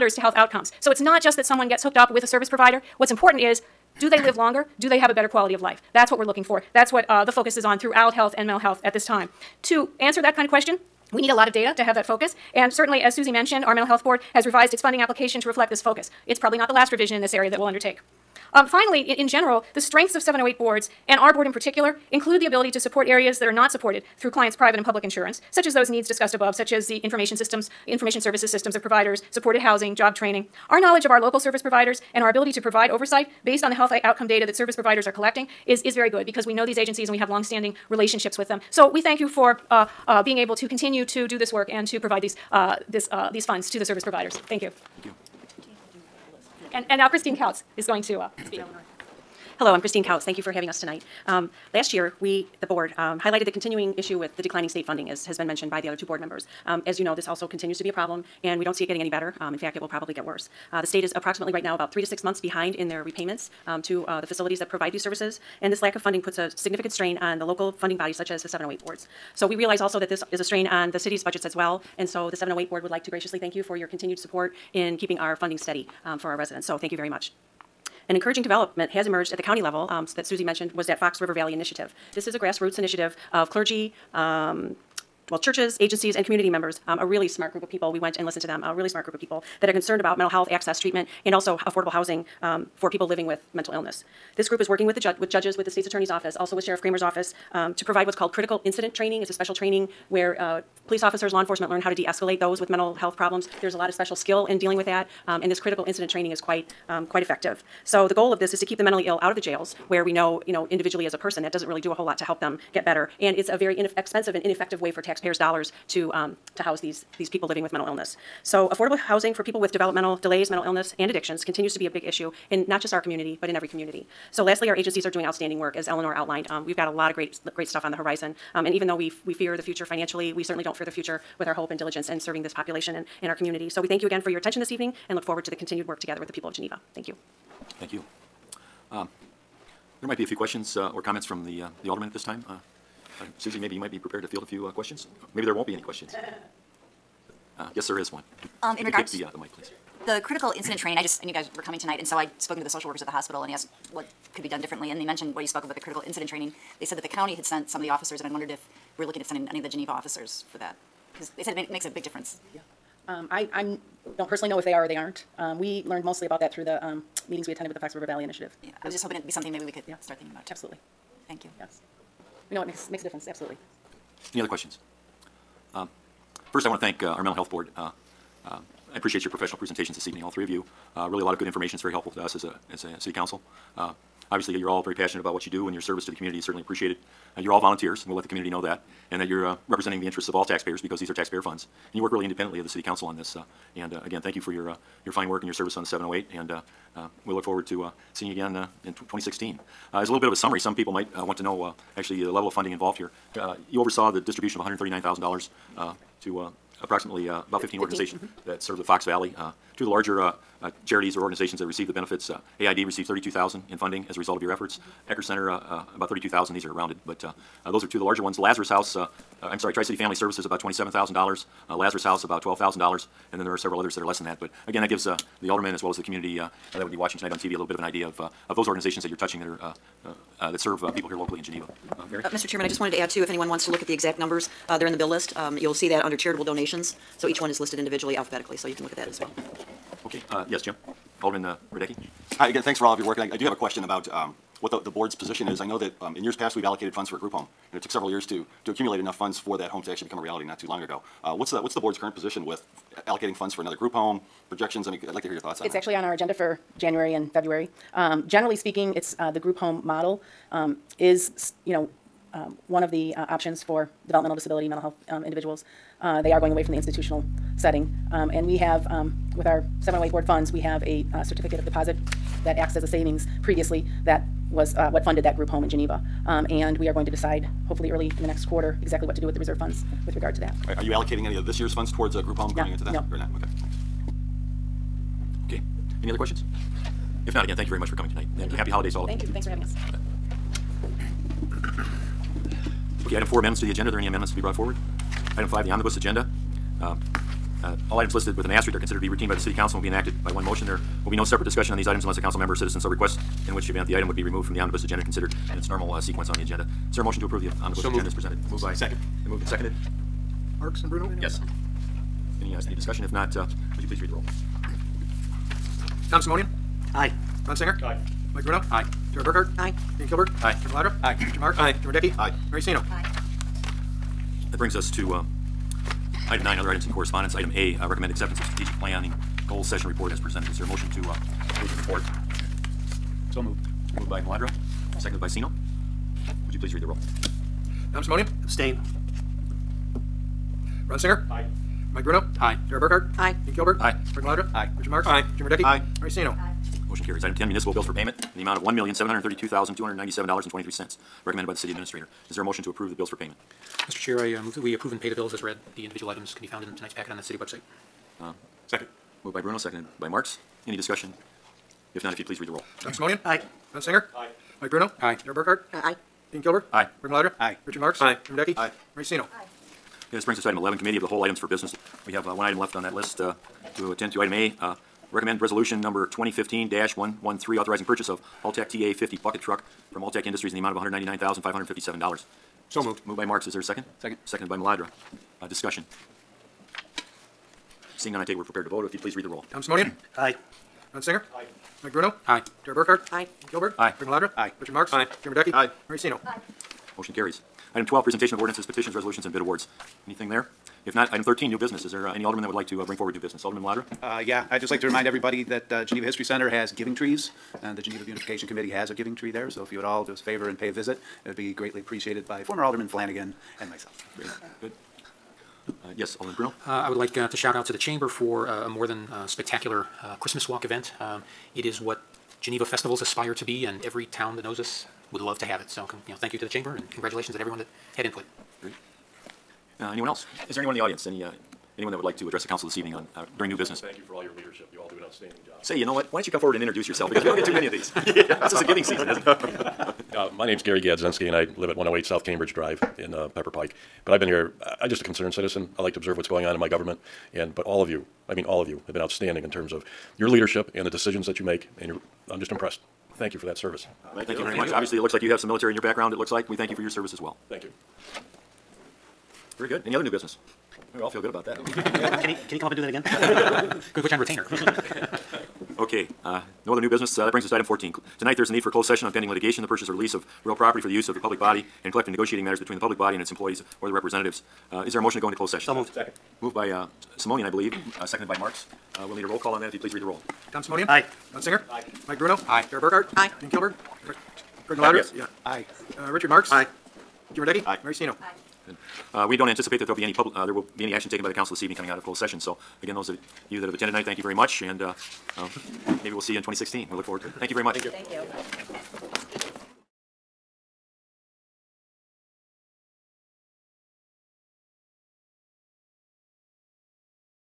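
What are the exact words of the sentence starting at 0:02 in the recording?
What's important is do they live longer?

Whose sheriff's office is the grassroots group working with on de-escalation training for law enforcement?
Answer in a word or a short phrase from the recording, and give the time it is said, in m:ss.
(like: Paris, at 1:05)
Sheriff Kramer's office, at 1:36.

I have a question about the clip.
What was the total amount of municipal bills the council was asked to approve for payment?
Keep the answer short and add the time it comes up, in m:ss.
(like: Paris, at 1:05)
$1,732,297.23, at 5:48.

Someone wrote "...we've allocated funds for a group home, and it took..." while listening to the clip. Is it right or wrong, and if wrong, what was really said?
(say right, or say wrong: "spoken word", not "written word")
right.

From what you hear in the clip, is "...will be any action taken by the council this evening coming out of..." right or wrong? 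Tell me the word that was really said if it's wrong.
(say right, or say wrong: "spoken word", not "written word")
right.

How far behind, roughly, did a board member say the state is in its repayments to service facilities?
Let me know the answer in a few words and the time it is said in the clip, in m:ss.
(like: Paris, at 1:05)
3 to 6 months, at 1:01.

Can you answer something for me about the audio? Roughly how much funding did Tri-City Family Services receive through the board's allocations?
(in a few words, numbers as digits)
$27,000.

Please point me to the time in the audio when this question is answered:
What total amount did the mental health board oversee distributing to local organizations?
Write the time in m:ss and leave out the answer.
3:24.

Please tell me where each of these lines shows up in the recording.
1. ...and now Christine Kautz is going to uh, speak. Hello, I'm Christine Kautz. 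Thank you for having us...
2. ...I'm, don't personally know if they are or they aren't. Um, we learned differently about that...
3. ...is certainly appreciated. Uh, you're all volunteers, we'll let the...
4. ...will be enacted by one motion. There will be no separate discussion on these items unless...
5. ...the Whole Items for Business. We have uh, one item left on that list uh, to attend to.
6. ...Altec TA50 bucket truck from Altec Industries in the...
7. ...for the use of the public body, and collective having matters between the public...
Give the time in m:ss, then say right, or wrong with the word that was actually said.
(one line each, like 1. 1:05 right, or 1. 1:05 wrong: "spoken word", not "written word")
1. 0:46 right
2. 2:43 wrong: "mostly", not "differently"
3. 3:06 right
4. 4:59 right
5. 6:11 right
6. 6:18 right
7. 7:50 wrong: "negotiating", not "having".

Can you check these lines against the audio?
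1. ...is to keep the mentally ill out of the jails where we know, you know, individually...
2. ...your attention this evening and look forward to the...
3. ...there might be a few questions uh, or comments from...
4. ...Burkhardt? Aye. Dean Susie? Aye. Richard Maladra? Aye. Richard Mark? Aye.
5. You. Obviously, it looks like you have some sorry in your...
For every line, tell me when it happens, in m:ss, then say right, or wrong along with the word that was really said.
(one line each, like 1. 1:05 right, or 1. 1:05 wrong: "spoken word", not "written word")
1. 1:48 right
2. 2:14 right
3. 2:20 right
4. 5:19 wrong: "Kilberg", not "Susie"
5. 7:34 wrong: "military", not "sorry".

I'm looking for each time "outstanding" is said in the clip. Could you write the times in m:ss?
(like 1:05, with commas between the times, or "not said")
2:05, 7:29.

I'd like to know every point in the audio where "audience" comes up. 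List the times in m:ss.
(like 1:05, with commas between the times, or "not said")
7:10.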